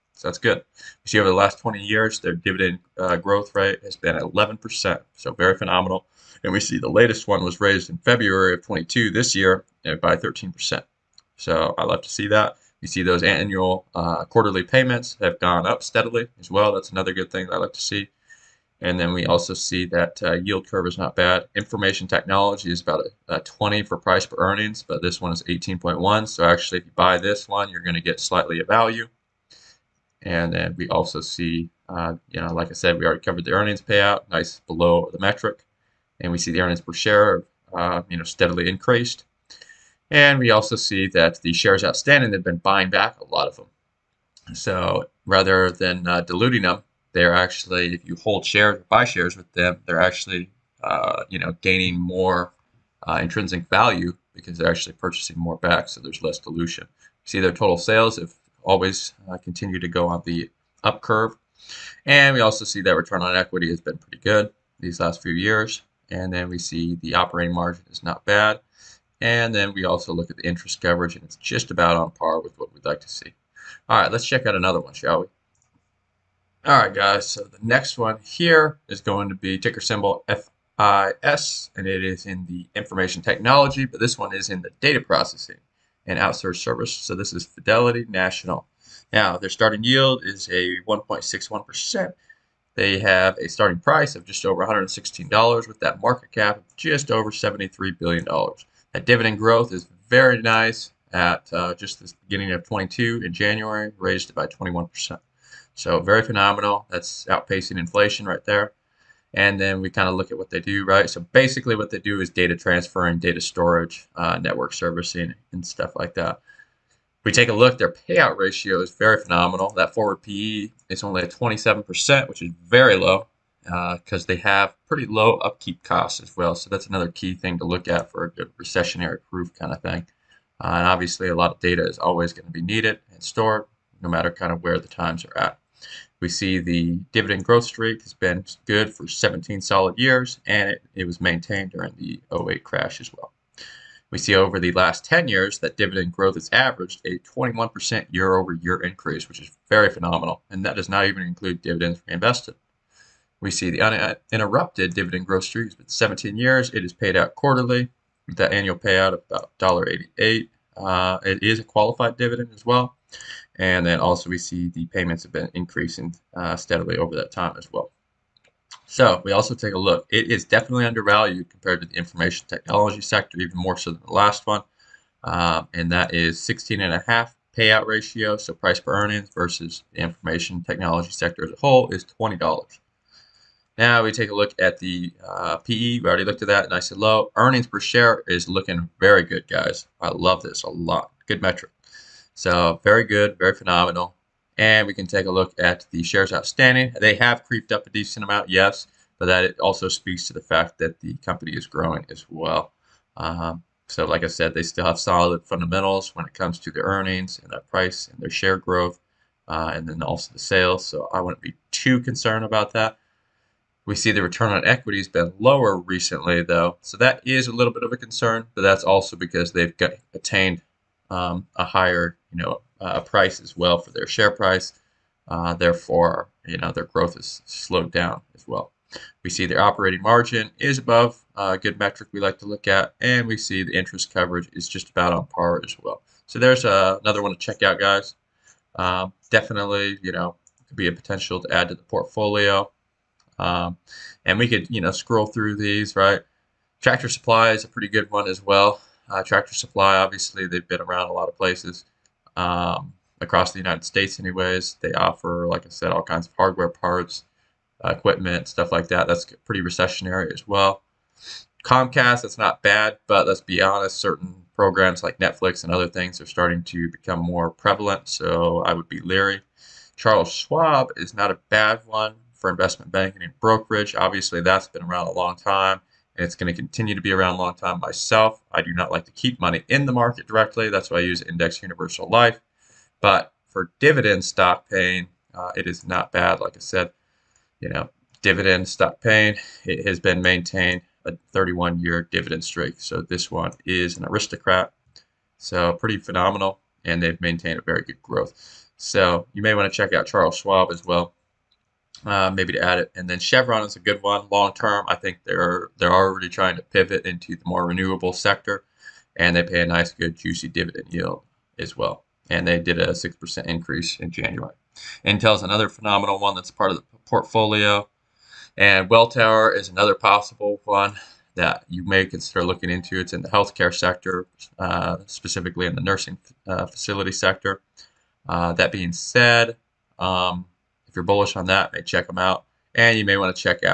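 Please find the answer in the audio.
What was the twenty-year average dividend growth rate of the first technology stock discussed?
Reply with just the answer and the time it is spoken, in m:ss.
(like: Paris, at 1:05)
11%, at 0:04.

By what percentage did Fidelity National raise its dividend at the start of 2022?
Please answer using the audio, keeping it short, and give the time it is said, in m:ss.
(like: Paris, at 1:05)
21%, at 1:43.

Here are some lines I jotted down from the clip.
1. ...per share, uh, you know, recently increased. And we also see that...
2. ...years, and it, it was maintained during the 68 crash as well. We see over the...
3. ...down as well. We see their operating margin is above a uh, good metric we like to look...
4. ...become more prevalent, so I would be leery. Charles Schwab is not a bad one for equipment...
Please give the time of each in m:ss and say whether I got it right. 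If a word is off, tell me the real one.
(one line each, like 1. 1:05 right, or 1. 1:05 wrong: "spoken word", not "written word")
1. 0:36 wrong: "steadily", not "recently"
2. 2:19 wrong: "08", not "68"
3. 3:47 right
4. 4:26 wrong: "investment", not "equipment".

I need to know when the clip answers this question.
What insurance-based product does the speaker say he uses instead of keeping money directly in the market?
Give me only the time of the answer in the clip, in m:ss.
4:41.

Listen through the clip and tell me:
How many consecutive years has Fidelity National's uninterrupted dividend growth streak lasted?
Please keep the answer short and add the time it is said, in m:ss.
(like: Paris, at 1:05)
17 years, at 2:35.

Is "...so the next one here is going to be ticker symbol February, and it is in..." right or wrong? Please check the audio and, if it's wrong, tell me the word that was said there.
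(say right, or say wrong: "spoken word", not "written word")
wrong: "FIS", not "February".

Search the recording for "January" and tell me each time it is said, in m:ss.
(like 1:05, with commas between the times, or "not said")
1:43, 5:14.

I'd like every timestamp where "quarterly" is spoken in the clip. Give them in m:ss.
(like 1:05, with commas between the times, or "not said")
0:14, 2:37.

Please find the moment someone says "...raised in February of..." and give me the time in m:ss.
0:07.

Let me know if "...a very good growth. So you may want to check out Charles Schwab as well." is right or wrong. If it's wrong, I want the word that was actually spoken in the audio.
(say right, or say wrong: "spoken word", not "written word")
right.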